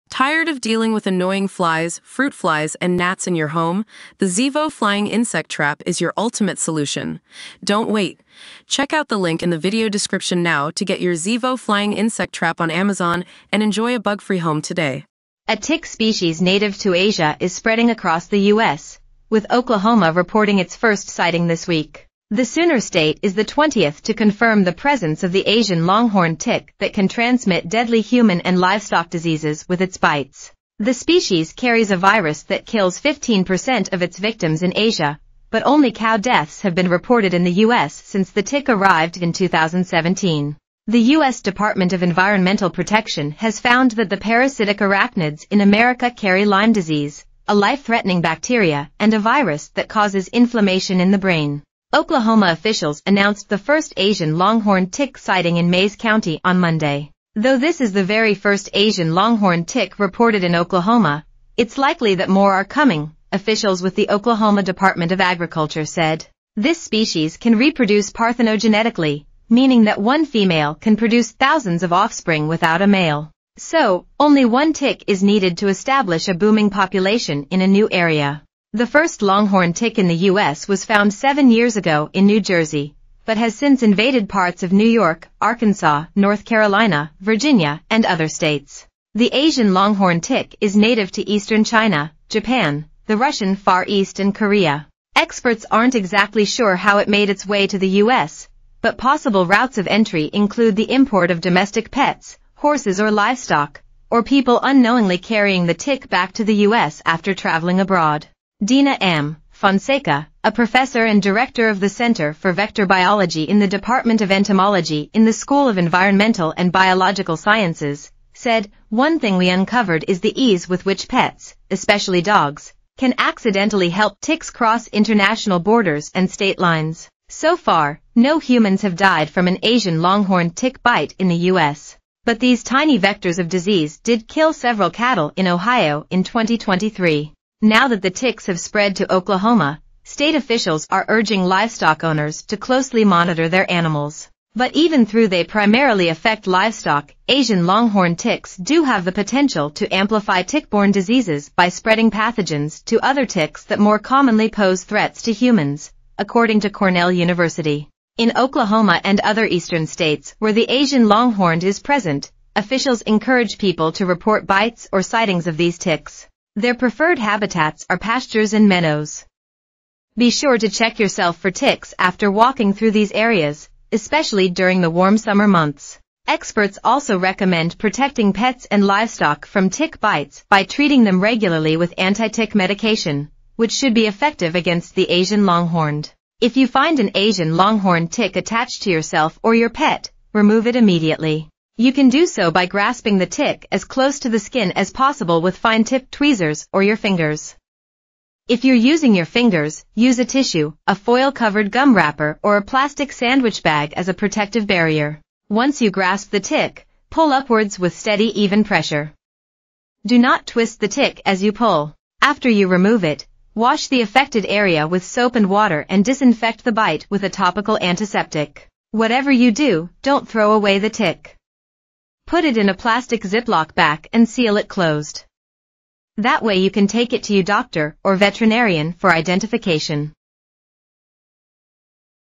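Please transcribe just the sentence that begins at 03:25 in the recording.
Once you grasp the tick, pull upwards with steady even pressure.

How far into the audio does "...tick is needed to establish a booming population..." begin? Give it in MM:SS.
01:14.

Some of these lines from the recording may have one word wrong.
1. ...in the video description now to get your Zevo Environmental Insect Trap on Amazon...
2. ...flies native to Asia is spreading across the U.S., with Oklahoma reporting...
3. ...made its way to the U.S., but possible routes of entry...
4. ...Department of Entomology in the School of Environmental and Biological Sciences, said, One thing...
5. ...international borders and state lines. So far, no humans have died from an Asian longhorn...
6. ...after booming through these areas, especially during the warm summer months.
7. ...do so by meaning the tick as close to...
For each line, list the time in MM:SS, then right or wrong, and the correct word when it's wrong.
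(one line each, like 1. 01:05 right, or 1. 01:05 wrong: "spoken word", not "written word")
1. 00:09 wrong: "Flying", not "Environmental"
2. 00:15 wrong: "species", not "flies"
3. 01:37 right
4. 01:53 right
5. 02:04 right
6. 02:51 wrong: "walking", not "booming"
7. 03:12 wrong: "grasping", not "meaning".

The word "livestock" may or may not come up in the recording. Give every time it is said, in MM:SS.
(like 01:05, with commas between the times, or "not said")
00:28, 01:43, 02:21, 02:26, 02:58.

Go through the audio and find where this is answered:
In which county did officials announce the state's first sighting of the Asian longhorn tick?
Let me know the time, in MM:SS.
00:55.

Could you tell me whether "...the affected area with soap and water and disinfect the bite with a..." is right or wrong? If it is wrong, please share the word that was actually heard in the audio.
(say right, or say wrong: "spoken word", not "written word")
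right.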